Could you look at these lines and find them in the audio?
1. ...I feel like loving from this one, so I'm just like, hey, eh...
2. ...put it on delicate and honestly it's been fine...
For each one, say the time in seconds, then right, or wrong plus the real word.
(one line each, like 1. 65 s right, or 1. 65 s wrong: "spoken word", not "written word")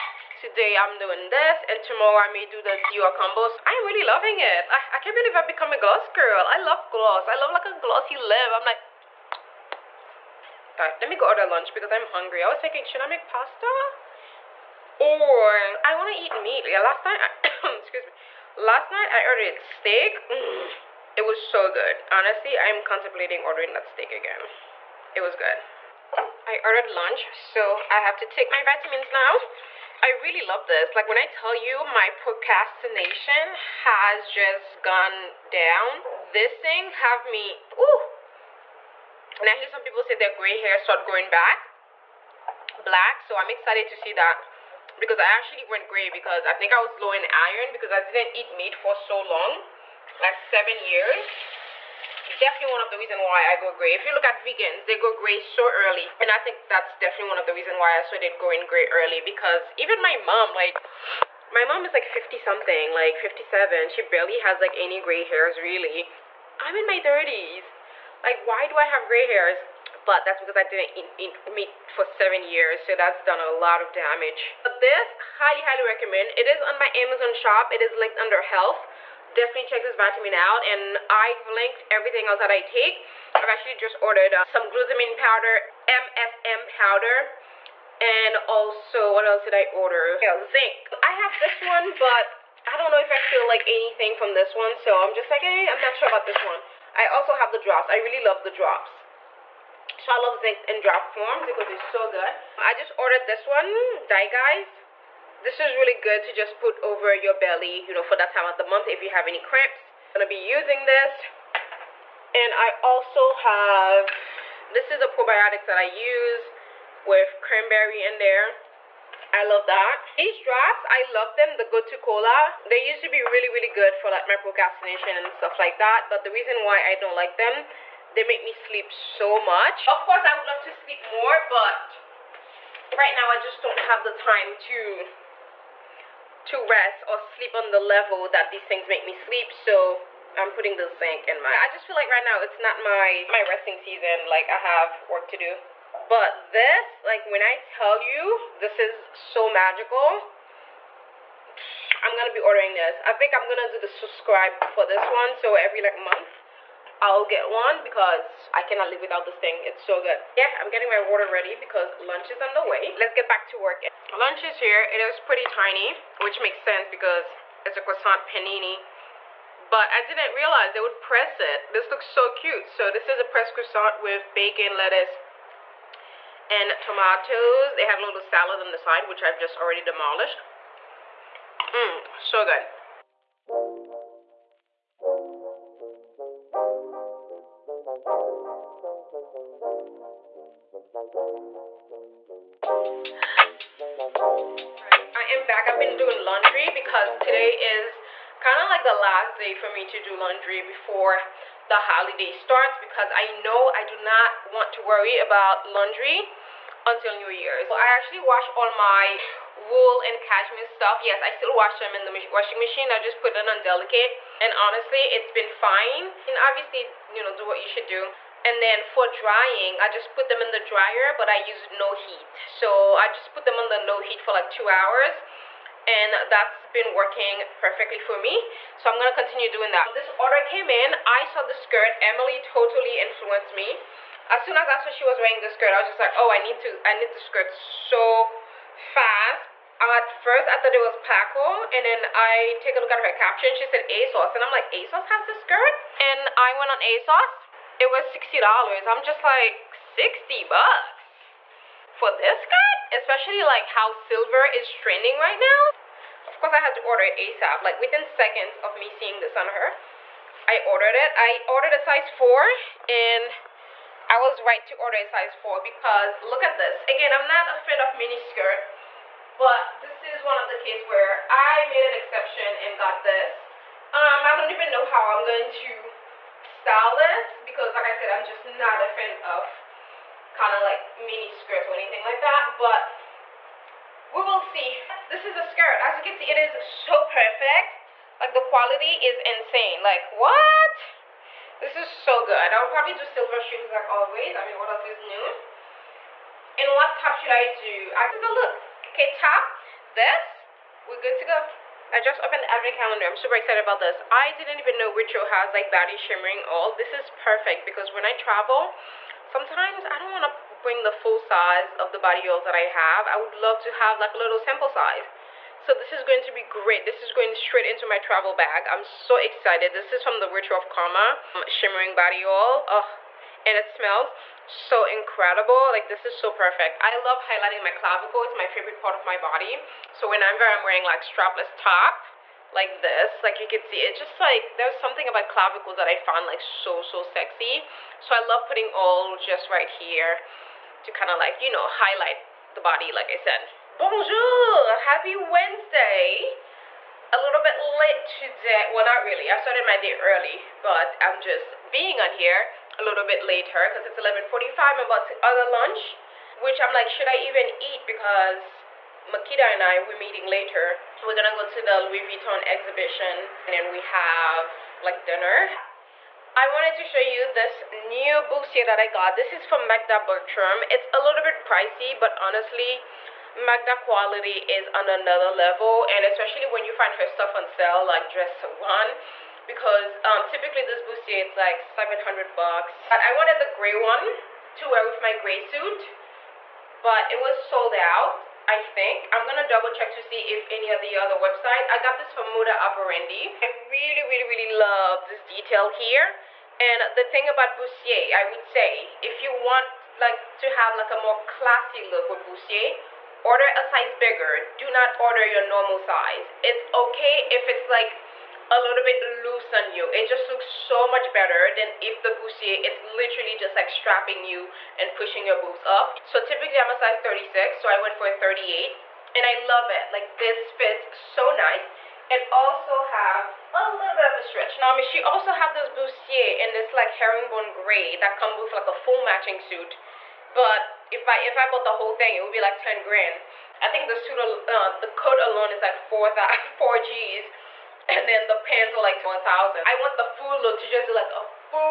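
1. 93 s wrong: "anything", not "loving"
2. 213 s right.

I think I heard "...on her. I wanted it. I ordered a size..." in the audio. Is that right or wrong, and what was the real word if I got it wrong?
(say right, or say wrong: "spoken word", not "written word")
wrong: "ordered", not "wanted".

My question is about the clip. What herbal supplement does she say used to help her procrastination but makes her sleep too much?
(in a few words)
Gotu kola.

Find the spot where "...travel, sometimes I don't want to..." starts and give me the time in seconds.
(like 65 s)
308 s.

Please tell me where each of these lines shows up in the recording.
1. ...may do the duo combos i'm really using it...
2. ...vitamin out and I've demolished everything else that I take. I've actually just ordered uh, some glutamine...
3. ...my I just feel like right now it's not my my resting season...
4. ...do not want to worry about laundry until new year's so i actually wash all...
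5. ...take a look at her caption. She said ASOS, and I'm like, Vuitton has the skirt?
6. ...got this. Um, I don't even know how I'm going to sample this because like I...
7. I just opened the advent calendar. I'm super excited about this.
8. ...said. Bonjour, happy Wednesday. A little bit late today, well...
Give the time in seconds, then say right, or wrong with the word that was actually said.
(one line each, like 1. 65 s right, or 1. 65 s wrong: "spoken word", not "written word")
1. 2 s wrong: "loving", not "using"
2. 79 s wrong: "linked", not "demolished"
3. 141 s right
4. 203 s right
5. 242 s wrong: "ASOS", not "Vuitton"
6. 272 s wrong: "style", not "sample"
7. 301 s right
8. 343 s right.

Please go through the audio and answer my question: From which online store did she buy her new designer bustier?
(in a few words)
Moda Operandi.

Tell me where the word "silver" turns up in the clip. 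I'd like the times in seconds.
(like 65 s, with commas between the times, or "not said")
253 s, 293 s.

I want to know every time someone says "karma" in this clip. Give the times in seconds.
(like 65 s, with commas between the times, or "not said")
320 s.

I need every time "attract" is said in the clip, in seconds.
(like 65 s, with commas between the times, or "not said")
not said.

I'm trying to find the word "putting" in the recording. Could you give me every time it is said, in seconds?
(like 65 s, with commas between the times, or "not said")
140 s, 338 s.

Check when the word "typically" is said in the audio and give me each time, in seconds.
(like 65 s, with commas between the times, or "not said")
380 s, 416 s.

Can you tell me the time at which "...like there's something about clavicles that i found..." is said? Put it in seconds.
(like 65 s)
334 s.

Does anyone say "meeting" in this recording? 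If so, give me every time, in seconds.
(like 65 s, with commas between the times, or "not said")
359 s.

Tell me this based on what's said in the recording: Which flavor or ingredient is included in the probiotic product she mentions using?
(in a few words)
Cranberry.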